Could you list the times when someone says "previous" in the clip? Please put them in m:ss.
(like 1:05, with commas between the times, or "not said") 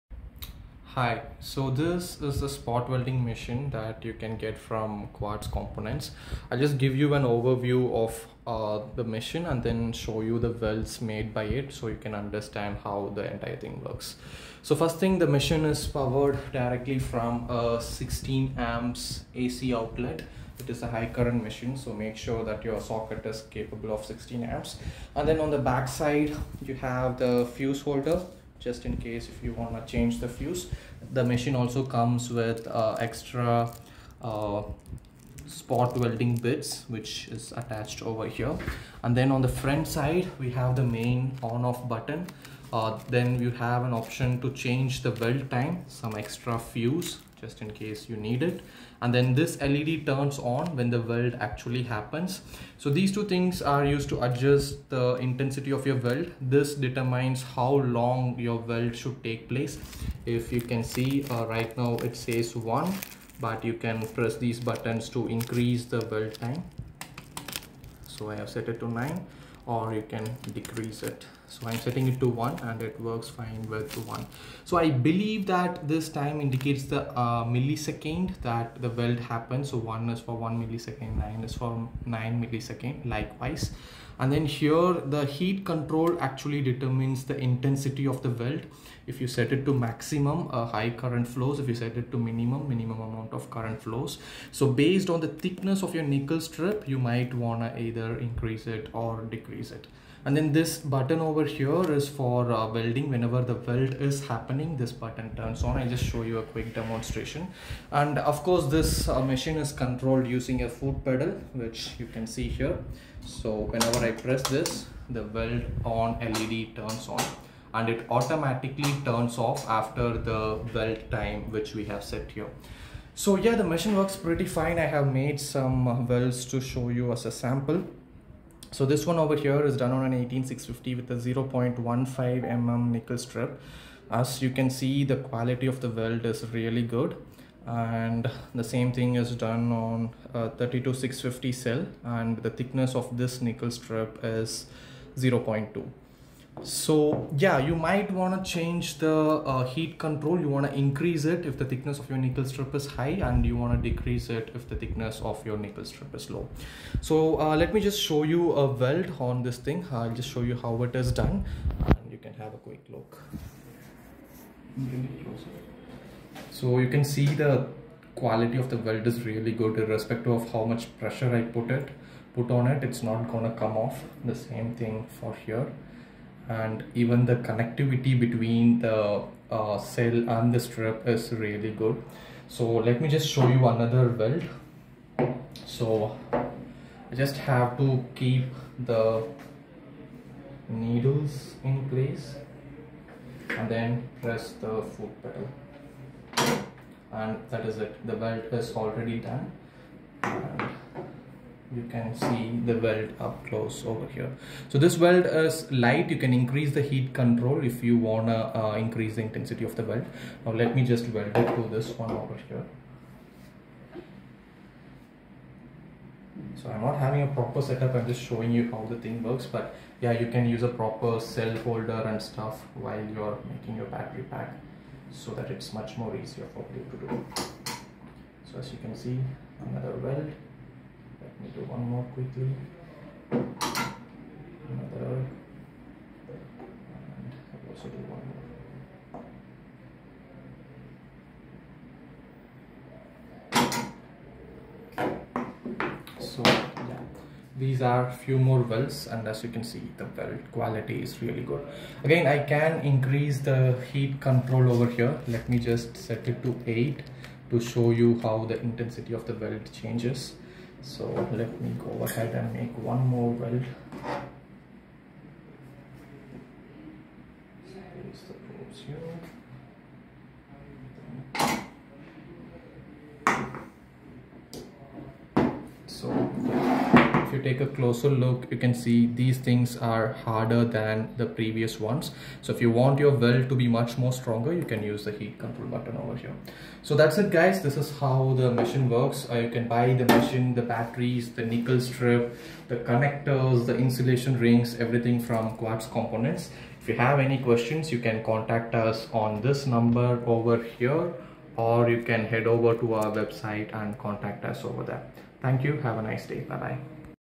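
4:41.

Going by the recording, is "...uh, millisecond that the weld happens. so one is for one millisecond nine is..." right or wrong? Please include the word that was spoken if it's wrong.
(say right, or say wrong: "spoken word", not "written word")
right.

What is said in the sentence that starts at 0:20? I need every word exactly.
It is a high current machine, so make sure that your socket is capable of 16 amps.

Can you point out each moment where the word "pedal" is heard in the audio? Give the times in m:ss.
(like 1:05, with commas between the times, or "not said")
1:51, 3:15.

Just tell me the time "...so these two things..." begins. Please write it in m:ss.
0:52.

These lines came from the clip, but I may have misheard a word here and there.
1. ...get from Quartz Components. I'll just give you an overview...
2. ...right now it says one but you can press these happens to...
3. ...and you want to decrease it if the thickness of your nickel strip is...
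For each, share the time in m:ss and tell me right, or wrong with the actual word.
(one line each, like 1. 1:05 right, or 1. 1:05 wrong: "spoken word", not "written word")
1. 0:04 right
2. 1:01 wrong: "buttons", not "happens"
3. 2:33 right.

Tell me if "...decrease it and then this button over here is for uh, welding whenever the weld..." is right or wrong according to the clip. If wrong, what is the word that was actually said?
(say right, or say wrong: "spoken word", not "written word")
right.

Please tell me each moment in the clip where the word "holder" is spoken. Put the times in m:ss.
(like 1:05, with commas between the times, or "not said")
0:27, 3:41.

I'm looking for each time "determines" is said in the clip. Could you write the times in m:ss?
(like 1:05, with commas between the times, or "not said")
0:56, 1:26.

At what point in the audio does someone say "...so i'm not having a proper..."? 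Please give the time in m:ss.
3:36.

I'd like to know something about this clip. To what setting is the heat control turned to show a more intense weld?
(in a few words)
8.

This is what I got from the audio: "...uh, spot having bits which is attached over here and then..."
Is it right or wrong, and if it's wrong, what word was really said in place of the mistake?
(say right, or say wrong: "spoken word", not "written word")
wrong: "welding", not "having".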